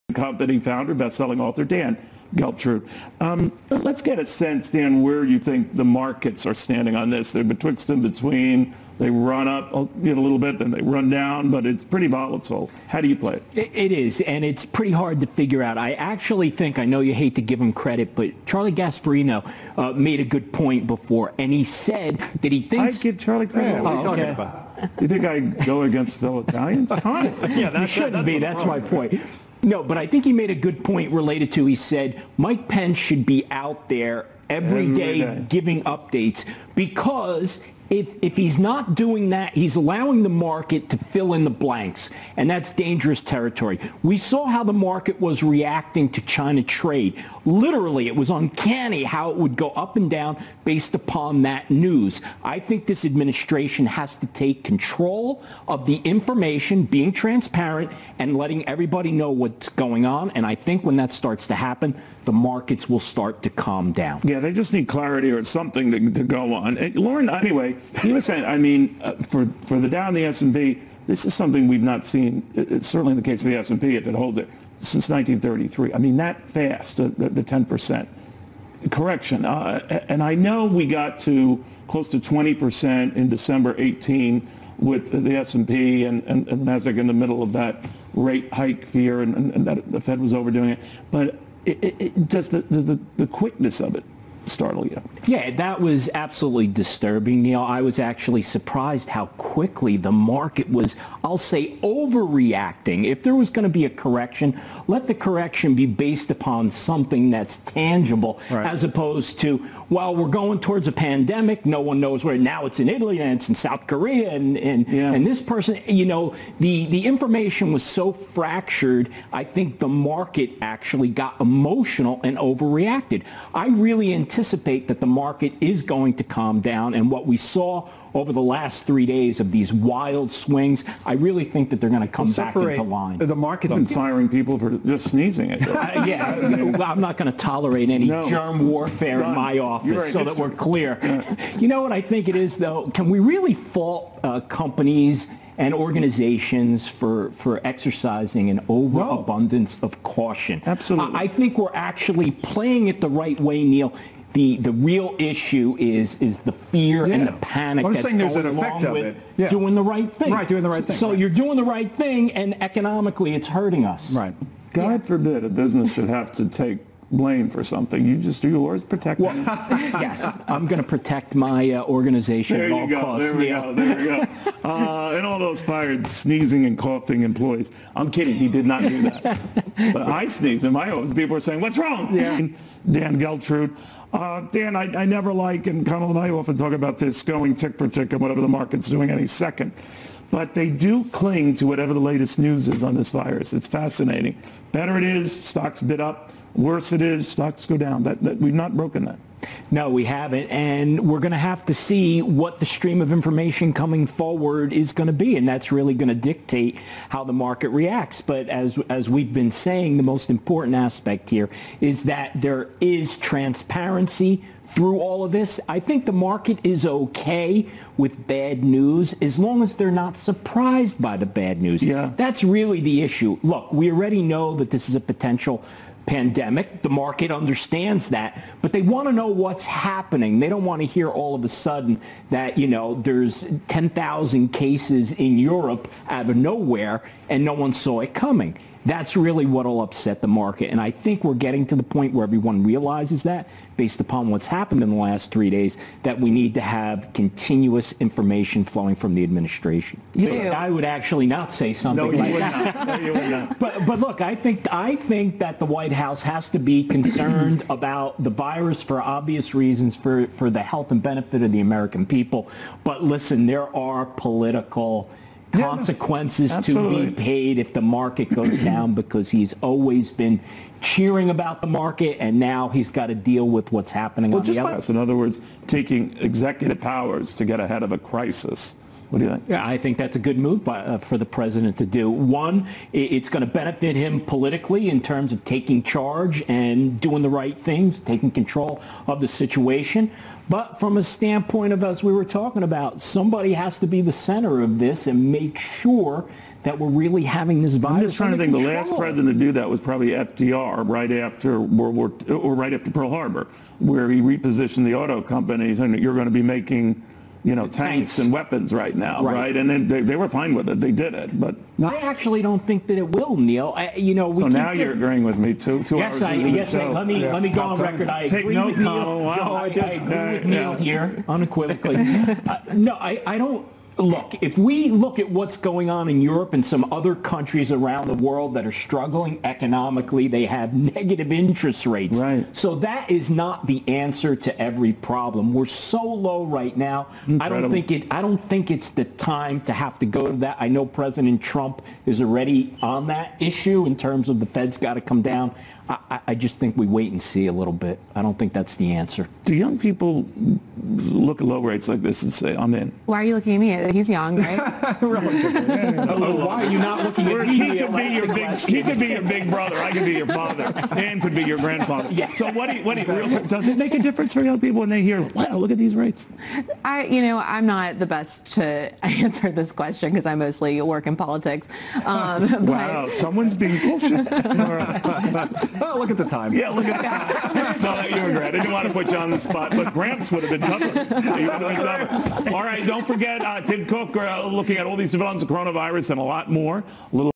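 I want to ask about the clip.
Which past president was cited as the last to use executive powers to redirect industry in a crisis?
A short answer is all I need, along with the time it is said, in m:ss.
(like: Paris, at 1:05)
FDR, at 5:00.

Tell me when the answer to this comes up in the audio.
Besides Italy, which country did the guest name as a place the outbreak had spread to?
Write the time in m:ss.
1:53.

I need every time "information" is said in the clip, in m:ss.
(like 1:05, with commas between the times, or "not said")
0:56, 1:57, 3:23, 4:07.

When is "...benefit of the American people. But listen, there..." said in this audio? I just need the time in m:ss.
4:21.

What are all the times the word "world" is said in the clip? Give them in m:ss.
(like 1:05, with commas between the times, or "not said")
5:01, 5:28.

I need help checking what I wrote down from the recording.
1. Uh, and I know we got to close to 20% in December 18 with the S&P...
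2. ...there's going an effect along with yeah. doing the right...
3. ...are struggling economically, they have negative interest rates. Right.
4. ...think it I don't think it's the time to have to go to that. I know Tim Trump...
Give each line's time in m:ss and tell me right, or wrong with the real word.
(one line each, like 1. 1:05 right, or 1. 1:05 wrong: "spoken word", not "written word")
1. 1:19 right
2. 2:38 right
3. 5:28 right
4. 5:37 wrong: "President", not "Tim".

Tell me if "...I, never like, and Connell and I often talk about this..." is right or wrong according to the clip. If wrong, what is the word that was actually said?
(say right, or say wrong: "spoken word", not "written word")
right.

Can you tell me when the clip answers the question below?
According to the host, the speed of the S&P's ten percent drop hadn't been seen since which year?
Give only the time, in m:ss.
1:15.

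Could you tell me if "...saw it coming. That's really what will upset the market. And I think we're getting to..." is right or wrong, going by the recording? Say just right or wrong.
right.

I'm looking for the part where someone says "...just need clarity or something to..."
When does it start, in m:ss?
1:04.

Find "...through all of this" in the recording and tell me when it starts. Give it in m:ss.
3:34.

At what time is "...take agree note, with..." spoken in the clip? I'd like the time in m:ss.
5:18.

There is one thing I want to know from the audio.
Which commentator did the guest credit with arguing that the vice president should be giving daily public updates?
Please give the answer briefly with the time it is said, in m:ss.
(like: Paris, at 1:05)
Charlie Gasparino, at 0:18.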